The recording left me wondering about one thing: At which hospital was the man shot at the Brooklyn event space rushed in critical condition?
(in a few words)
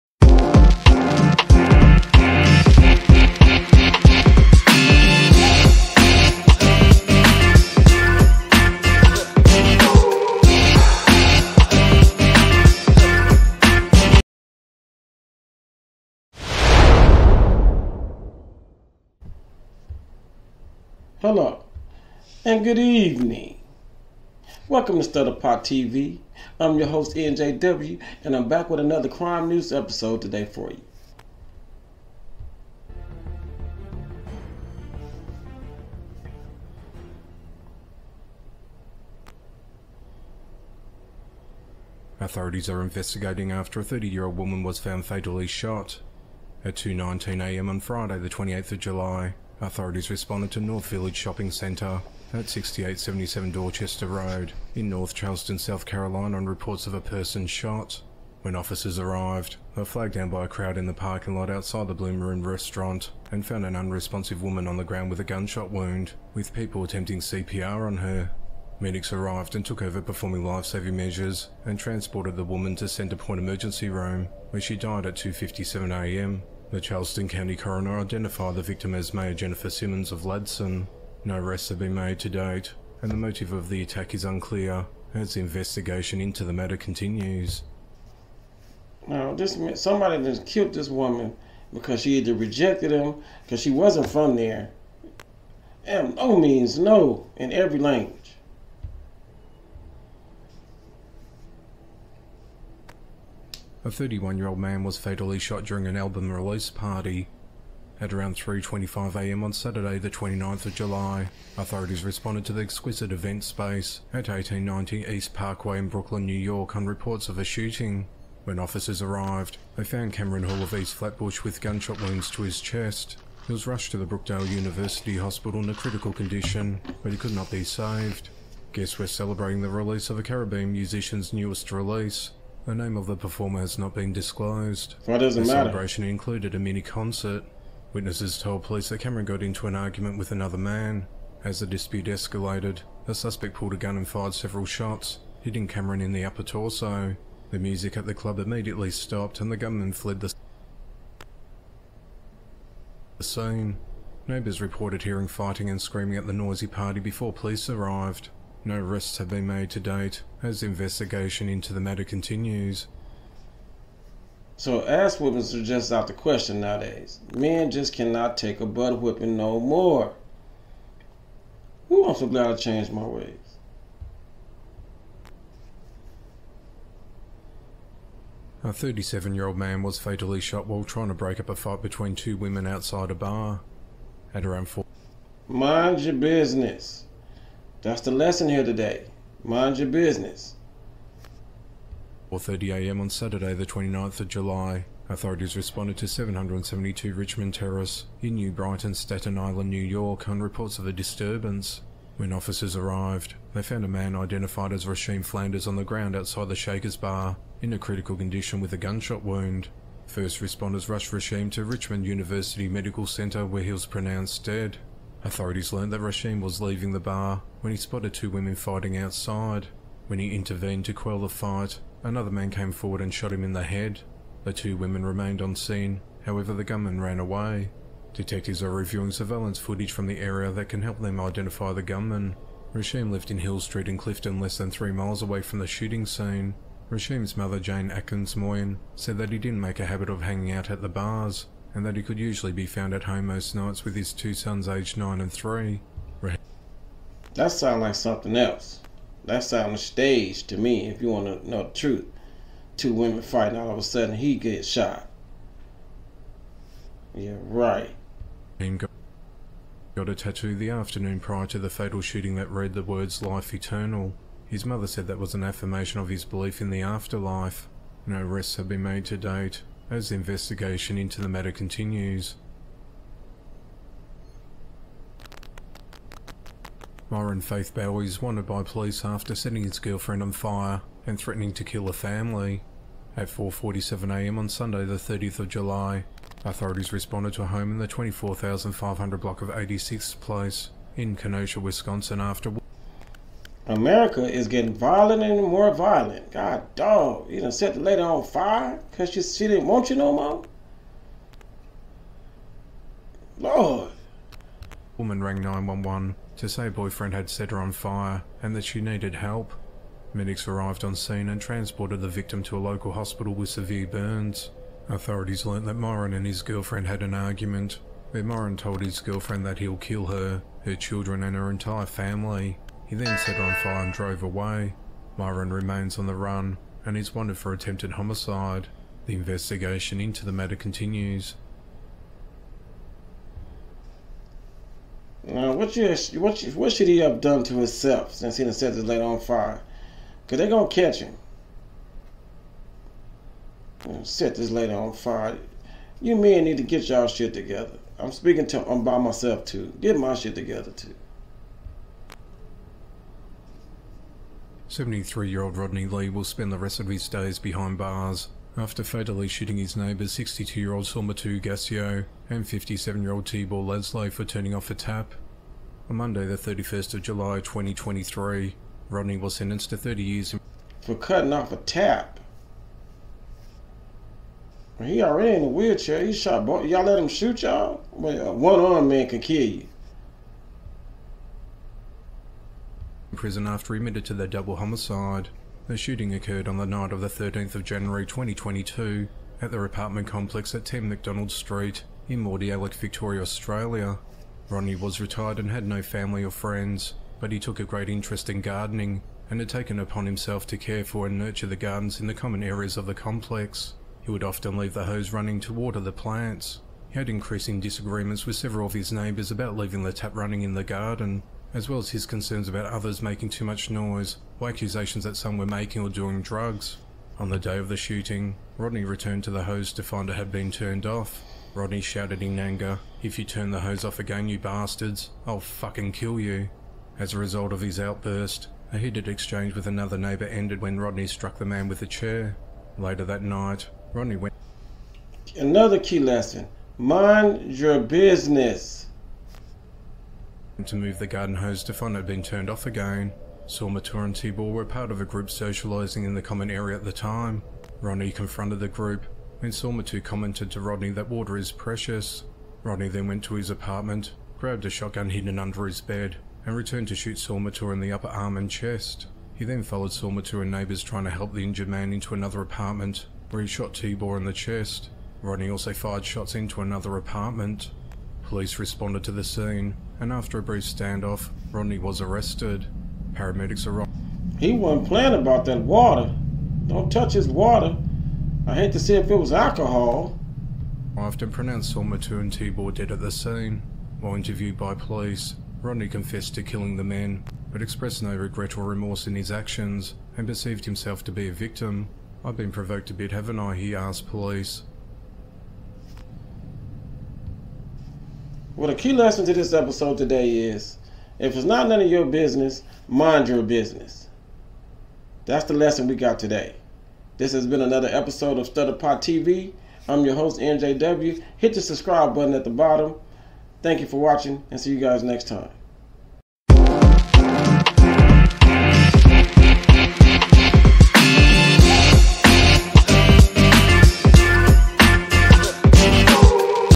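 Brookdale University Hospital.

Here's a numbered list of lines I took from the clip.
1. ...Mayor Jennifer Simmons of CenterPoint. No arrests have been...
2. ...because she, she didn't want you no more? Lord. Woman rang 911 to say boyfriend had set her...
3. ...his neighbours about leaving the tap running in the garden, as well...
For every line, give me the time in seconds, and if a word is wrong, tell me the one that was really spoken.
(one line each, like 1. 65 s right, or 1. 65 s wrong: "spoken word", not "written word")
1. 79 s wrong: "Ladson", not "CenterPoint"
2. 298 s right
3. 408 s right.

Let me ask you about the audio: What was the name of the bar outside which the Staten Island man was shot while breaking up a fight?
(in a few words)
Shaker's Bar.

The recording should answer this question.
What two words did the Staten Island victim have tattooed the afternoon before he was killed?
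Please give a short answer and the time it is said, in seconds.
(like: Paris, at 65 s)
Life Eternal, at 263 s.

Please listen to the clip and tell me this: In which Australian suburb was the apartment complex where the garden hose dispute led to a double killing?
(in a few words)
Mordialloc.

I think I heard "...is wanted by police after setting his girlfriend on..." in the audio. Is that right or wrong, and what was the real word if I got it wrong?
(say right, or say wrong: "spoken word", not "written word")
right.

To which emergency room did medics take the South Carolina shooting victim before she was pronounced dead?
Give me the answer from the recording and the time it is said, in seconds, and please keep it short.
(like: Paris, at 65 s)
CenterPoint Emergency Room, at 72 s.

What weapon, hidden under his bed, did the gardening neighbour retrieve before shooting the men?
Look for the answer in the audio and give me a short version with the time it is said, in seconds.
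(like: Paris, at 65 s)
shotgun, at 454 s.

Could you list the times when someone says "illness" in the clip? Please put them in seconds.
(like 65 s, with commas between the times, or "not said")
not said.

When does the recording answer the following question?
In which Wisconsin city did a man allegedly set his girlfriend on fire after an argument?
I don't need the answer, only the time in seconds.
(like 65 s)
291 s.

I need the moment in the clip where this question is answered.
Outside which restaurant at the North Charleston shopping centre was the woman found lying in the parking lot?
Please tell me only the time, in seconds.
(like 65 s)
61 s.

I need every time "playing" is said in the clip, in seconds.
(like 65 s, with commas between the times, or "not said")
474 s.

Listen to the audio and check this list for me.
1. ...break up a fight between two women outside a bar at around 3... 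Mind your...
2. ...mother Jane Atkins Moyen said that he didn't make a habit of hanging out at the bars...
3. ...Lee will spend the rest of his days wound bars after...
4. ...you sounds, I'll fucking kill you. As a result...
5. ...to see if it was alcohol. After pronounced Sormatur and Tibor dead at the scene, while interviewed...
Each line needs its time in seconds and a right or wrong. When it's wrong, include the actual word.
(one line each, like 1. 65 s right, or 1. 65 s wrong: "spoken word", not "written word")
1. 181 s wrong: "4", not "3"
2. 237 s right
3. 355 s wrong: "behind", not "wound"
4. 424 s wrong: "bastards", not "sounds"
5. 478 s right.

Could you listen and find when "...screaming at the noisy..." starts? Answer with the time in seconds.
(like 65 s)
155 s.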